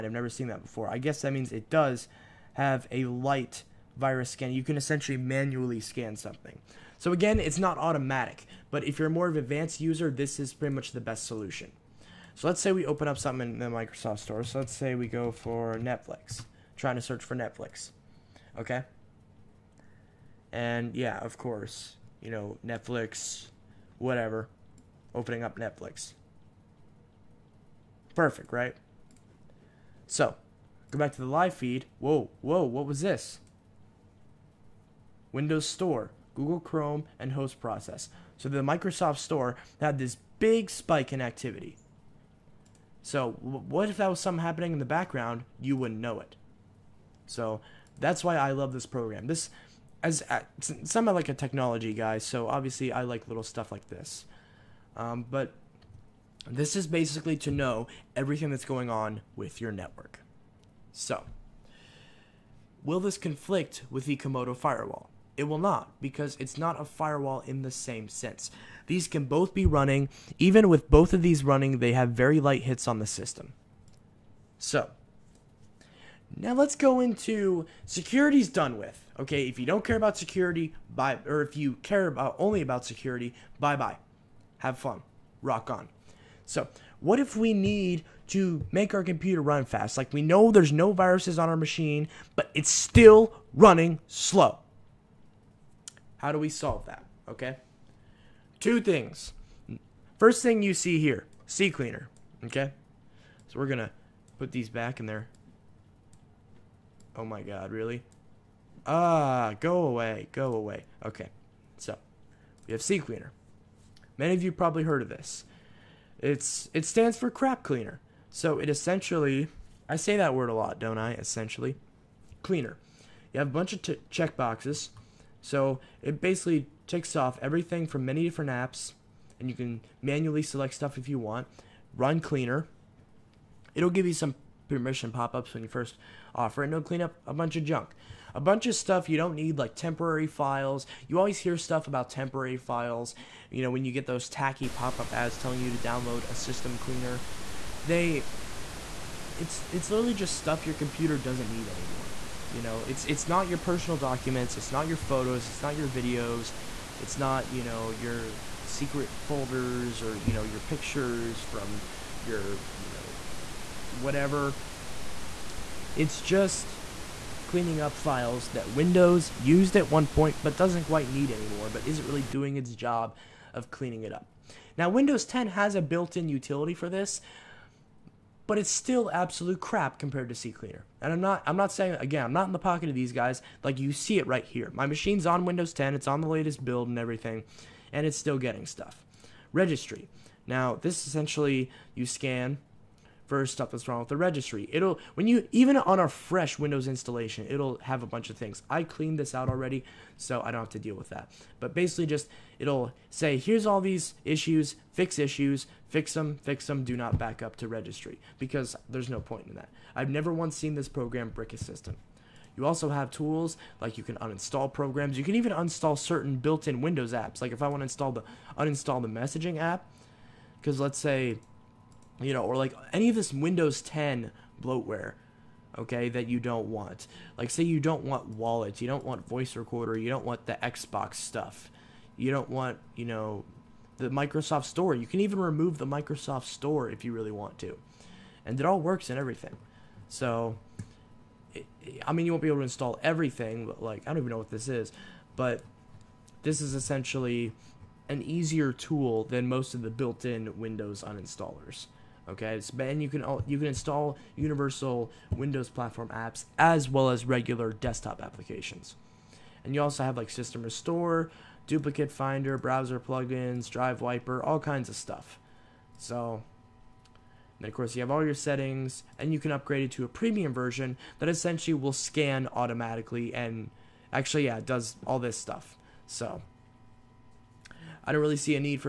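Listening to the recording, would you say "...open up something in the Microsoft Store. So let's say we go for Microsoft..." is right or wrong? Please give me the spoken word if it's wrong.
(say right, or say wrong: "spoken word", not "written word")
wrong: "Netflix", not "Microsoft".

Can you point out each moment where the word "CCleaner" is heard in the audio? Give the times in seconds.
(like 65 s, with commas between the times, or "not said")
101 s, 112 s, 180 s.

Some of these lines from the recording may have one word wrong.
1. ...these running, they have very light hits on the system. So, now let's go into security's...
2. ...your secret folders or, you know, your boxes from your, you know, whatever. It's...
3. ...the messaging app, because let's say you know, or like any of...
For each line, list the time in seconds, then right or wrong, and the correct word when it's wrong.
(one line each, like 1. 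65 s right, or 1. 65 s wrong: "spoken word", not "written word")
1. 71 s right
2. 157 s wrong: "pictures", not "boxes"
3. 219 s right.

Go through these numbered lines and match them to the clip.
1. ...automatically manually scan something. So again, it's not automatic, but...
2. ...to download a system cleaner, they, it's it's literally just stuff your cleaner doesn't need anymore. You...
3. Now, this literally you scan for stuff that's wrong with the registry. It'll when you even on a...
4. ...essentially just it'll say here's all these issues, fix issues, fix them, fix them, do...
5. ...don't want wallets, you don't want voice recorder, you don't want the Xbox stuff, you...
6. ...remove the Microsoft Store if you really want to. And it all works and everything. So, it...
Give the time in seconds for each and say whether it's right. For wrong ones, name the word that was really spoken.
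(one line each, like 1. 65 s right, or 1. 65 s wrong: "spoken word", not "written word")
1. 4 s wrong: "essentially", not "automatically"
2. 145 s wrong: "computer", not "cleaner"
3. 190 s wrong: "essentially", not "literally"
4. 201 s wrong: "basically", not "essentially"
5. 227 s right
6. 235 s right.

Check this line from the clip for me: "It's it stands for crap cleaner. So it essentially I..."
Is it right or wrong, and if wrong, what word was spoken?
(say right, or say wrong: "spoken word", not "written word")
right.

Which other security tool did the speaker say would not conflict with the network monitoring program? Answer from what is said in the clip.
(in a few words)
Comodo firewall.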